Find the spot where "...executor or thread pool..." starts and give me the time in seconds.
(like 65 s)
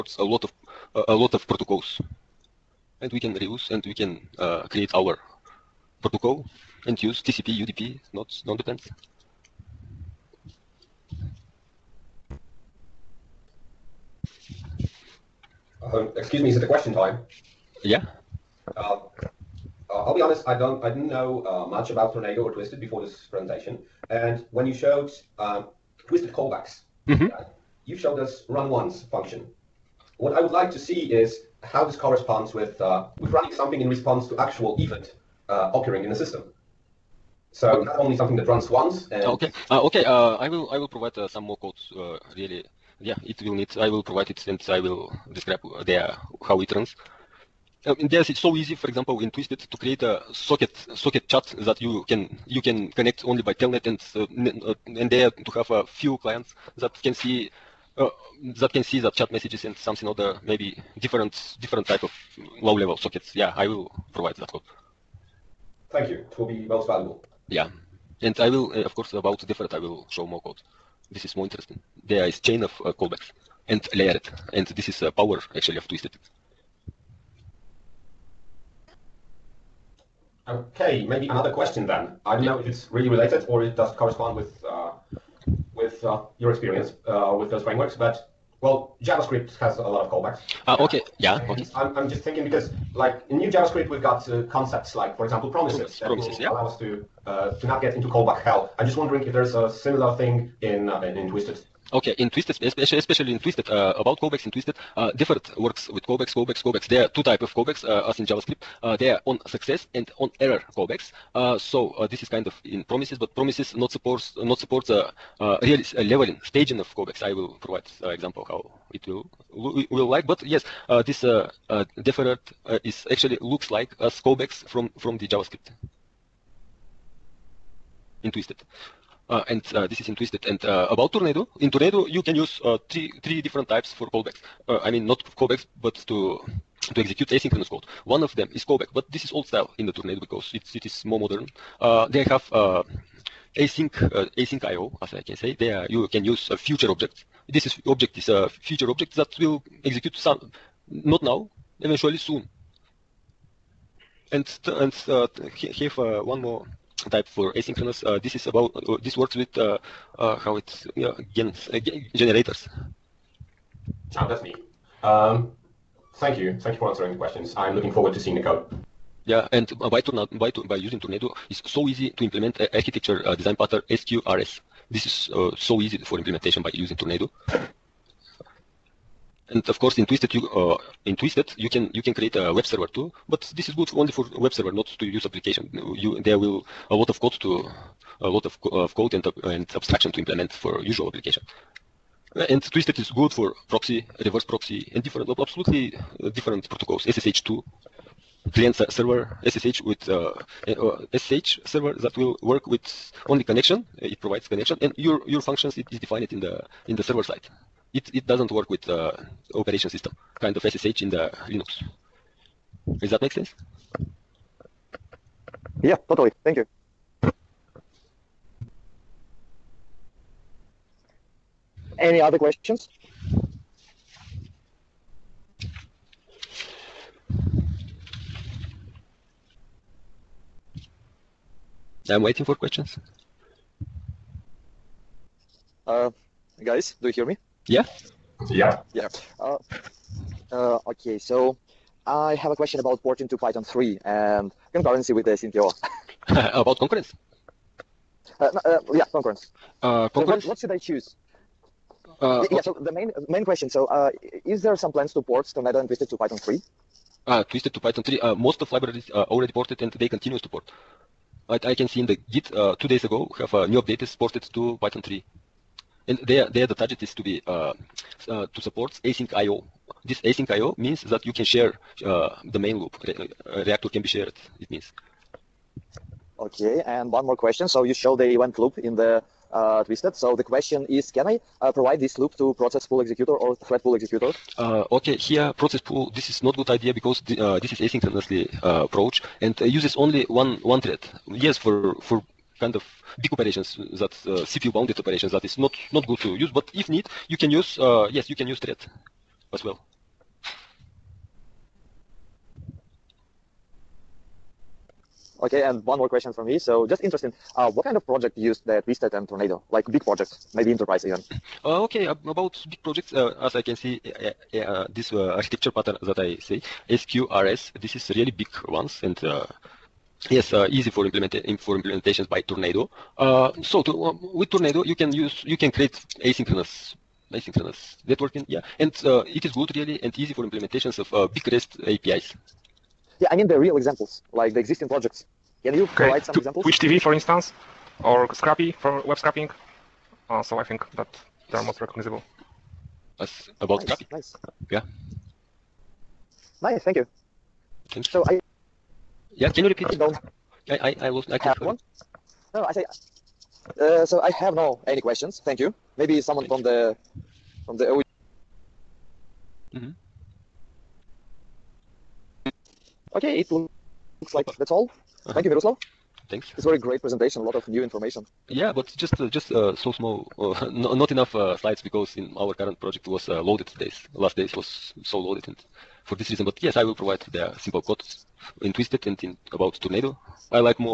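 283 s.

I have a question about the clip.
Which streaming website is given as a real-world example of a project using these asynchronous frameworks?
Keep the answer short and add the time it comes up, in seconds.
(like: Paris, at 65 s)
Twitch TV, at 336 s.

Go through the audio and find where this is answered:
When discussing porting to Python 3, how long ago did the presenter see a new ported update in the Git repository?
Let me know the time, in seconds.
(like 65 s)
262 s.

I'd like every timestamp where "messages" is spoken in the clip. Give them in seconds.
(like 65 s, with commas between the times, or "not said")
59 s.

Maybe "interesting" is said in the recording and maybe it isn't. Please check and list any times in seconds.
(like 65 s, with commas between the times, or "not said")
71 s, 307 s.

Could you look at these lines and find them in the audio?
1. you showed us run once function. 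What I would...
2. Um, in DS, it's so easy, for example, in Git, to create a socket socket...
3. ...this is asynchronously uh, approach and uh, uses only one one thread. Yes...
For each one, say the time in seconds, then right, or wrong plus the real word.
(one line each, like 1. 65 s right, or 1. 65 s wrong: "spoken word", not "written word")
1. 27 s right
2. 47 s wrong: "Twisted", not "Git"
3. 287 s right.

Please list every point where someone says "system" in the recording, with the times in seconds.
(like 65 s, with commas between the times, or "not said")
36 s, 209 s.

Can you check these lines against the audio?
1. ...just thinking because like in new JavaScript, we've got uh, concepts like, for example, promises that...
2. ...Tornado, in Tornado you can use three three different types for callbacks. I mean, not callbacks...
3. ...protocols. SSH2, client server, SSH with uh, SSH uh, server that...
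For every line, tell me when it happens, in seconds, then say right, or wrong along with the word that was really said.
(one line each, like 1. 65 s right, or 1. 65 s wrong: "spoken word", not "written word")
1. 92 s right
2. 131 s right
3. 196 s right.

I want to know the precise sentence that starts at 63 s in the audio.
Yeah, I will provide that code.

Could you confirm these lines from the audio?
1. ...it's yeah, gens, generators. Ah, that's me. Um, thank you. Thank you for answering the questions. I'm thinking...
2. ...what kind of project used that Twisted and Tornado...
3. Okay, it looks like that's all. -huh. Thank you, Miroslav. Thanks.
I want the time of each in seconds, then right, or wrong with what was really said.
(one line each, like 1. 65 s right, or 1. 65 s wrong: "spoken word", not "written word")
1. 160 s wrong: "looking", not "thinking"
2. 307 s right
3. 363 s right.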